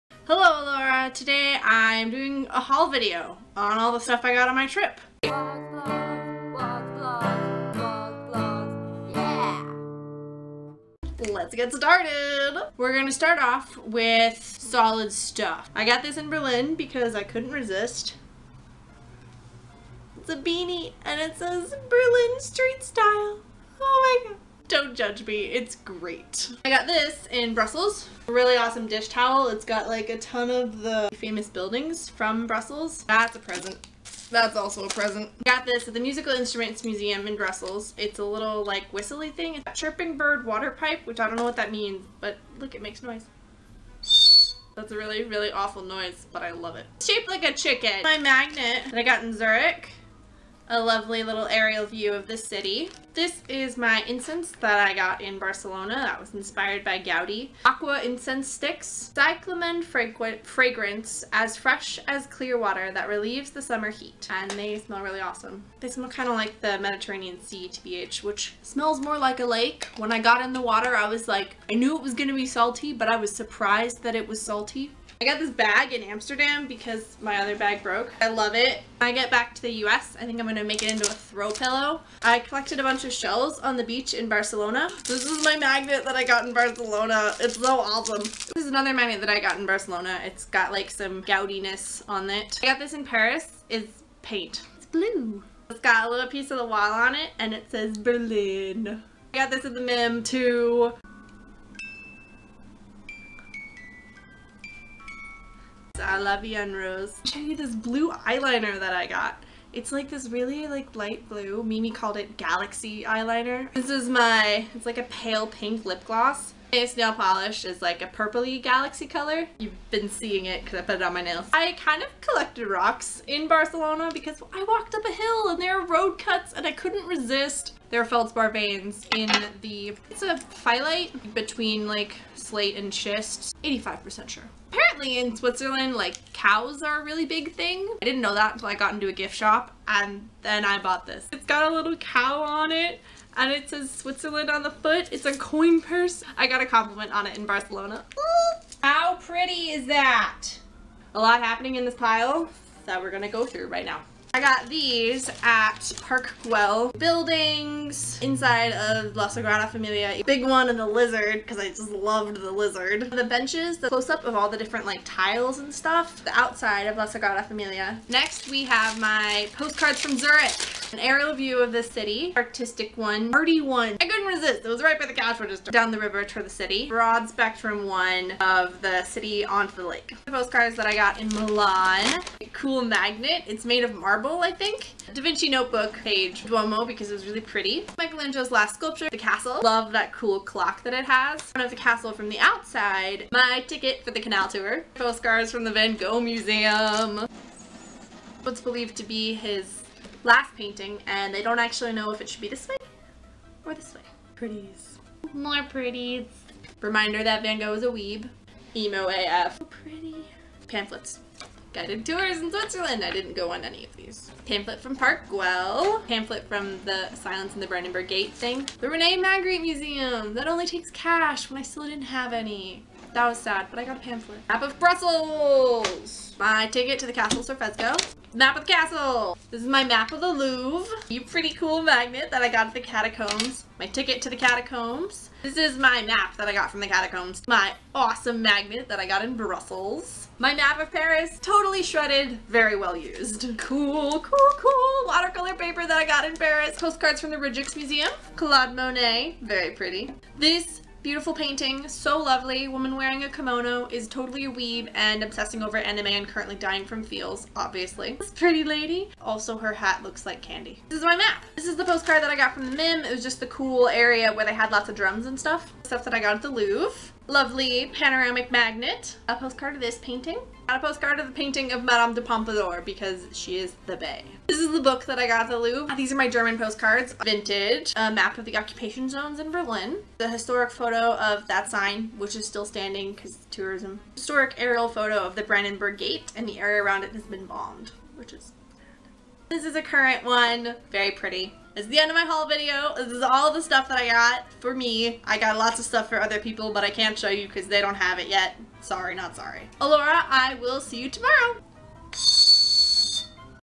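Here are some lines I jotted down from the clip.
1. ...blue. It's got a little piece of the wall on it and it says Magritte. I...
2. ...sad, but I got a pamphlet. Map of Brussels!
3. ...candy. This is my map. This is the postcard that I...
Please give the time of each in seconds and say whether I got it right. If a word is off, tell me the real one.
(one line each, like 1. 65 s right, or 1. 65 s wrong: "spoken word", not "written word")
1. 94 s wrong: "Berlin", not "Magritte"
2. 223 s right
3. 260 s right.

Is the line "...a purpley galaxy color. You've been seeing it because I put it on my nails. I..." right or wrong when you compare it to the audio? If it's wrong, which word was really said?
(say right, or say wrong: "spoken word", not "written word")
right.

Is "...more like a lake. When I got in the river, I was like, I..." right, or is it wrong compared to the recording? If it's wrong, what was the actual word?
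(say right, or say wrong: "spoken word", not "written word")
wrong: "water", not "river".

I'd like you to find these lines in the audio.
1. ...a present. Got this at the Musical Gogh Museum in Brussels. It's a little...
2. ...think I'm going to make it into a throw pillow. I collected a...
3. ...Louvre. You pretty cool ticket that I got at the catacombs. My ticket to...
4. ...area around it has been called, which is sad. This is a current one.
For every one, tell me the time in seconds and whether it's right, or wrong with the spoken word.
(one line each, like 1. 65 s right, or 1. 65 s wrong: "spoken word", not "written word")
1. 34 s wrong: "Instruments", not "Gogh"
2. 80 s right
3. 230 s wrong: "magnet", not "ticket"
4. 286 s wrong: "bombed", not "called".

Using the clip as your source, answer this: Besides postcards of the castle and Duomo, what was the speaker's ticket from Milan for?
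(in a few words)
canal tour.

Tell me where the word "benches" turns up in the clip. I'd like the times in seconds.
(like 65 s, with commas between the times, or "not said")
163 s.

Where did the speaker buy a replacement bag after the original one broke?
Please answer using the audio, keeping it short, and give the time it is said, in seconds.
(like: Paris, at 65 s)
Amsterdam, at 76 s.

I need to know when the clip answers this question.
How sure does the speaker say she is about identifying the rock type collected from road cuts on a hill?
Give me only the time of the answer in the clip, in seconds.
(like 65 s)
133 s.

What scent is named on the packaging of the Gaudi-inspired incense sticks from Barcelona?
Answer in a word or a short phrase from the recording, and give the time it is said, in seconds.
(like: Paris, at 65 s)
cyclamen, at 59 s.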